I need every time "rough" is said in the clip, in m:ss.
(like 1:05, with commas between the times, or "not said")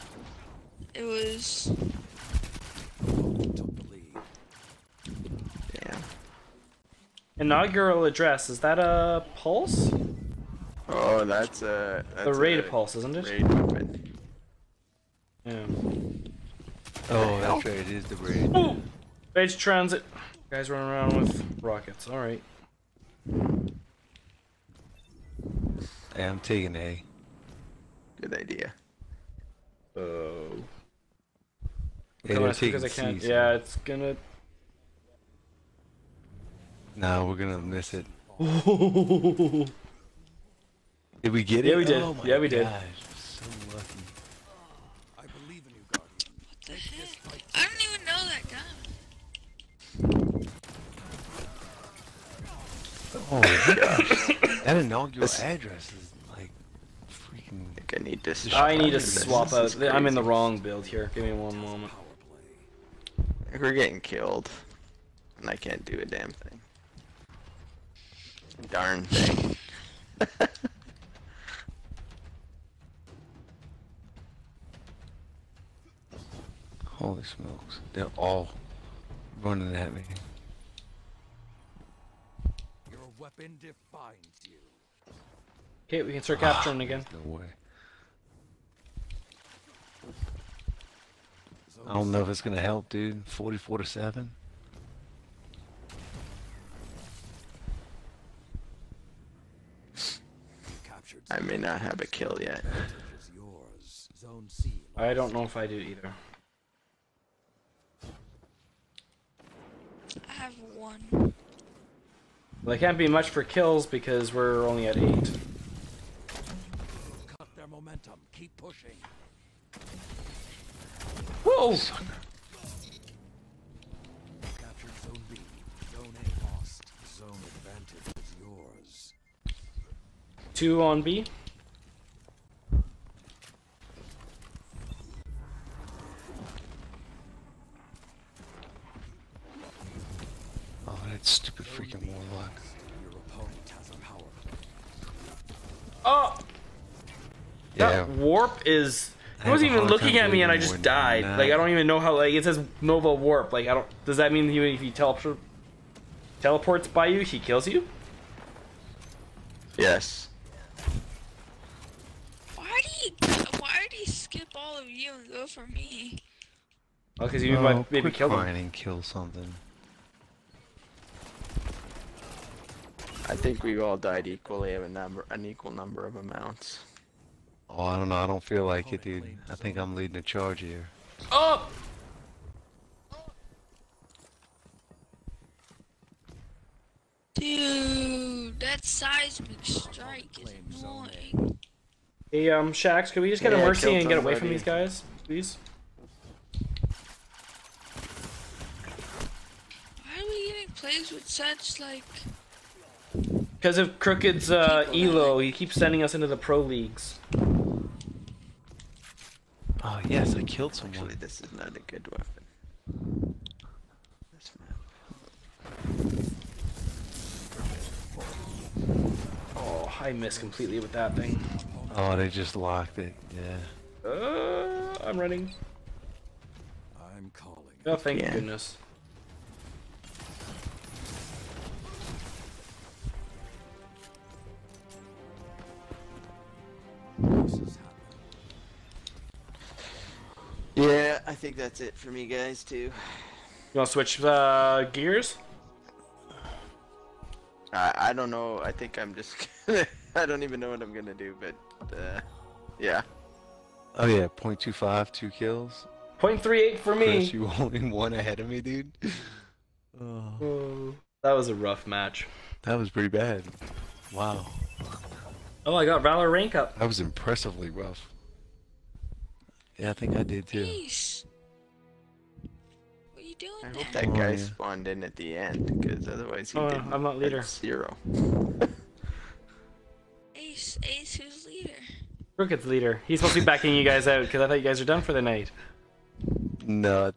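4:21, 4:27.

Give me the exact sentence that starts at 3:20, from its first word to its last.
Why are we getting plays with such, like...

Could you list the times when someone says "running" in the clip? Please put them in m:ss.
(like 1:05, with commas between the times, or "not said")
0:20, 1:19, 3:45.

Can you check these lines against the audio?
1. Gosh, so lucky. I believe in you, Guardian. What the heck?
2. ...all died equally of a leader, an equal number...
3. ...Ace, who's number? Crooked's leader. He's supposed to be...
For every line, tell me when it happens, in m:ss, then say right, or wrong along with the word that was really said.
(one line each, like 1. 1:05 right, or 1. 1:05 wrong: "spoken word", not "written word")
1. 0:42 right
2. 2:53 wrong: "number", not "leader"
3. 4:40 wrong: "leader", not "number".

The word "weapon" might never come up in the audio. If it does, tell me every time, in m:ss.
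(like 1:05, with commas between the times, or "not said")
0:13, 1:23, 3:32.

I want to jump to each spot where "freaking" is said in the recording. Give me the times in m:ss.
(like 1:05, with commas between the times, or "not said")
0:57, 2:21.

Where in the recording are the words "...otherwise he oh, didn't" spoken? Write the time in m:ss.
4:36.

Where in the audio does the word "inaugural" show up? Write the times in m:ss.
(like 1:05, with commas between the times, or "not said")
0:07, 0:54.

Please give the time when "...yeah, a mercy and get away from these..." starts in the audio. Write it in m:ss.
3:13.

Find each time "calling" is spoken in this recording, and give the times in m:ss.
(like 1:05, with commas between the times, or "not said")
3:47.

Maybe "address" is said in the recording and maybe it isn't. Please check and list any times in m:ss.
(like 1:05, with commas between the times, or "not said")
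0:08, 0:55.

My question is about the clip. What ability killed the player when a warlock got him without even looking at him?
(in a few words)
Nova Warp.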